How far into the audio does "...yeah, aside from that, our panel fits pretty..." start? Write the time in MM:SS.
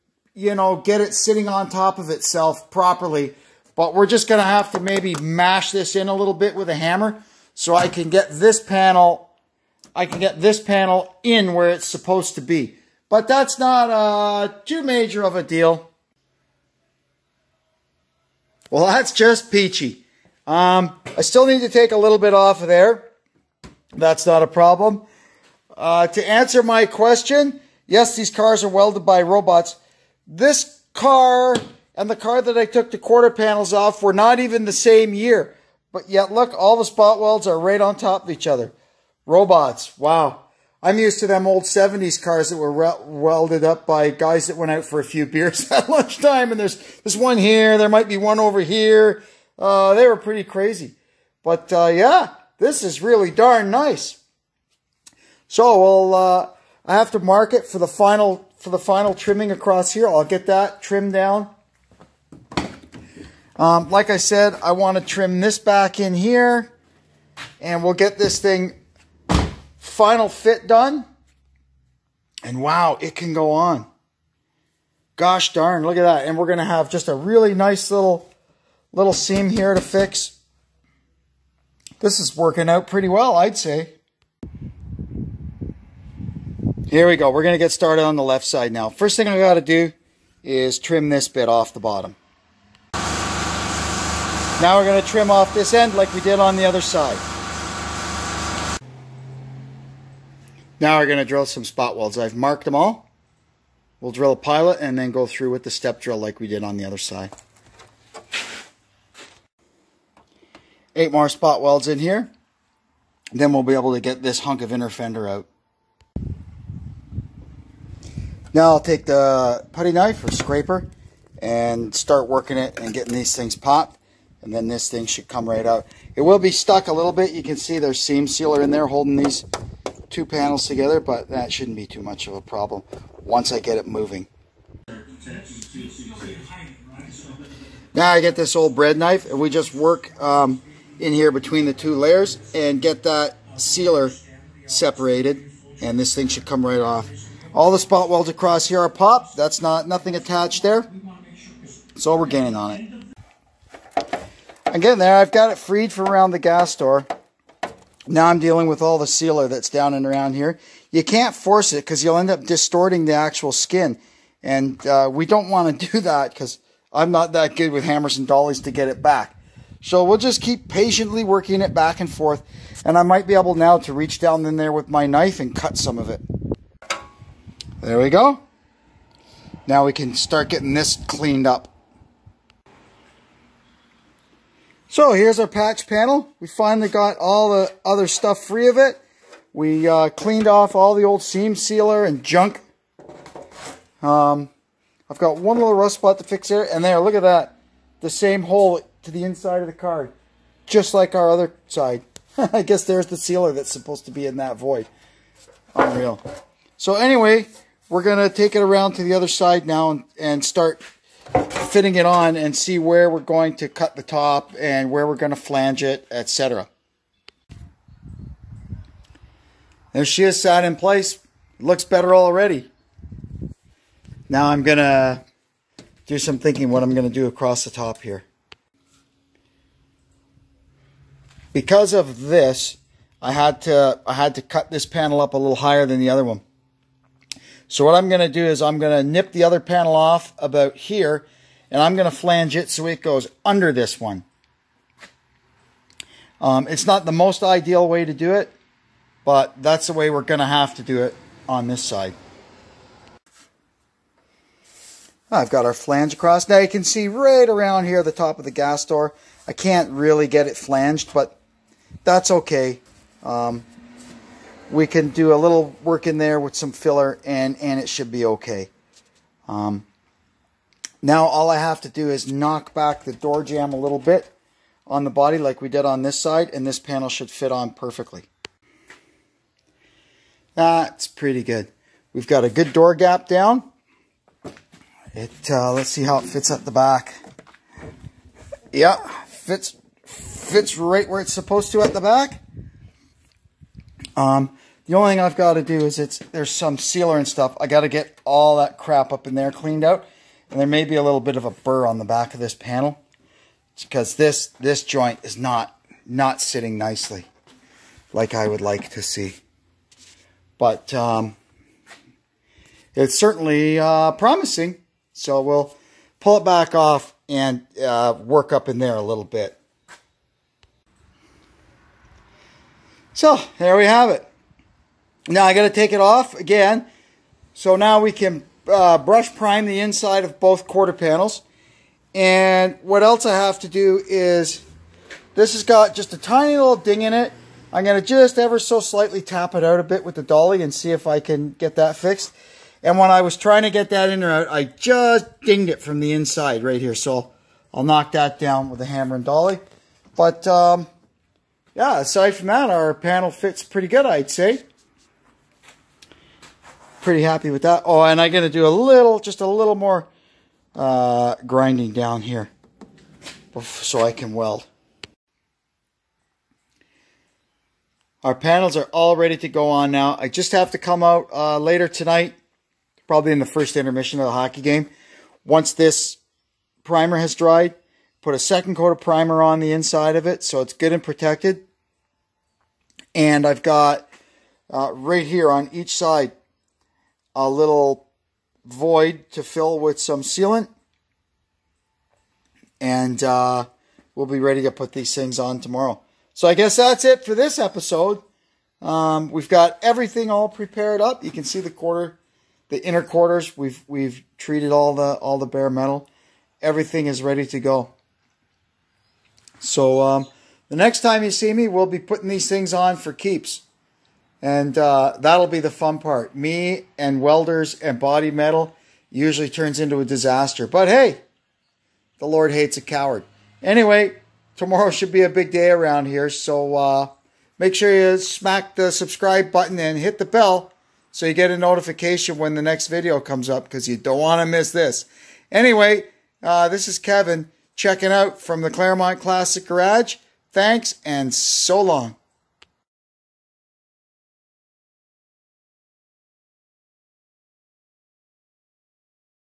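05:51.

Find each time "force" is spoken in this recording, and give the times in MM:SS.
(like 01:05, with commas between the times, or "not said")
02:41.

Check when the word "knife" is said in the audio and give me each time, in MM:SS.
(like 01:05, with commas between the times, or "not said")
01:59, 02:18, 02:55.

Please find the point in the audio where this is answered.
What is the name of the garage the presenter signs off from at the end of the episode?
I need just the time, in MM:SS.
07:18.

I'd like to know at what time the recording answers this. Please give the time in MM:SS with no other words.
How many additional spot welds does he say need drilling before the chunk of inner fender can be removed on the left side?
01:50.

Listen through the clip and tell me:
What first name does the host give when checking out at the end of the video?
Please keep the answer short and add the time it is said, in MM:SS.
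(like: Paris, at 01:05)
Kevin, at 07:16.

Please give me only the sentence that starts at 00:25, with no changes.
Uh, to answer my question, yes, these cars are welded by robots.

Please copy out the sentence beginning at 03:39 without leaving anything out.
There she is sat in place.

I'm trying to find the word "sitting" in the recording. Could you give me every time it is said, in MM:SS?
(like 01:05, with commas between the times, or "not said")
00:01, 05:06.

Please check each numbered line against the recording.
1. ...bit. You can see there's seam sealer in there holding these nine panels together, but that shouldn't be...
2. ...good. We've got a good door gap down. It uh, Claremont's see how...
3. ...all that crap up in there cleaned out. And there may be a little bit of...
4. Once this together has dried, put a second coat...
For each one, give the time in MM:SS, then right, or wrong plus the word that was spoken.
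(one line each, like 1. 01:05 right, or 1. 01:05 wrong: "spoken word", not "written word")
1. 02:07 wrong: "two", not "nine"
2. 04:41 wrong: "Let", not "Claremont"
3. 04:58 right
4. 06:15 wrong: "primer", not "together".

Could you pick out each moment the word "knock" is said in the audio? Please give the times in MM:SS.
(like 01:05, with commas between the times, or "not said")
04:32, 05:47.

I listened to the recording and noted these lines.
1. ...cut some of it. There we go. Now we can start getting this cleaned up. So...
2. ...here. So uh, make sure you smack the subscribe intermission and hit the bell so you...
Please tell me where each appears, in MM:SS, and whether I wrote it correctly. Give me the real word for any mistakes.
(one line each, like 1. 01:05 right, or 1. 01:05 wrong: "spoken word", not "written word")
1. 02:55 right
2. 07:06 wrong: "button", not "intermission".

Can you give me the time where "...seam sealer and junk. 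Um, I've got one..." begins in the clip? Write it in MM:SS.
03:11.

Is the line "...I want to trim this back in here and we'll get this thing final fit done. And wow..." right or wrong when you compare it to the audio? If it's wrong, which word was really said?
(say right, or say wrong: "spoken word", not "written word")
right.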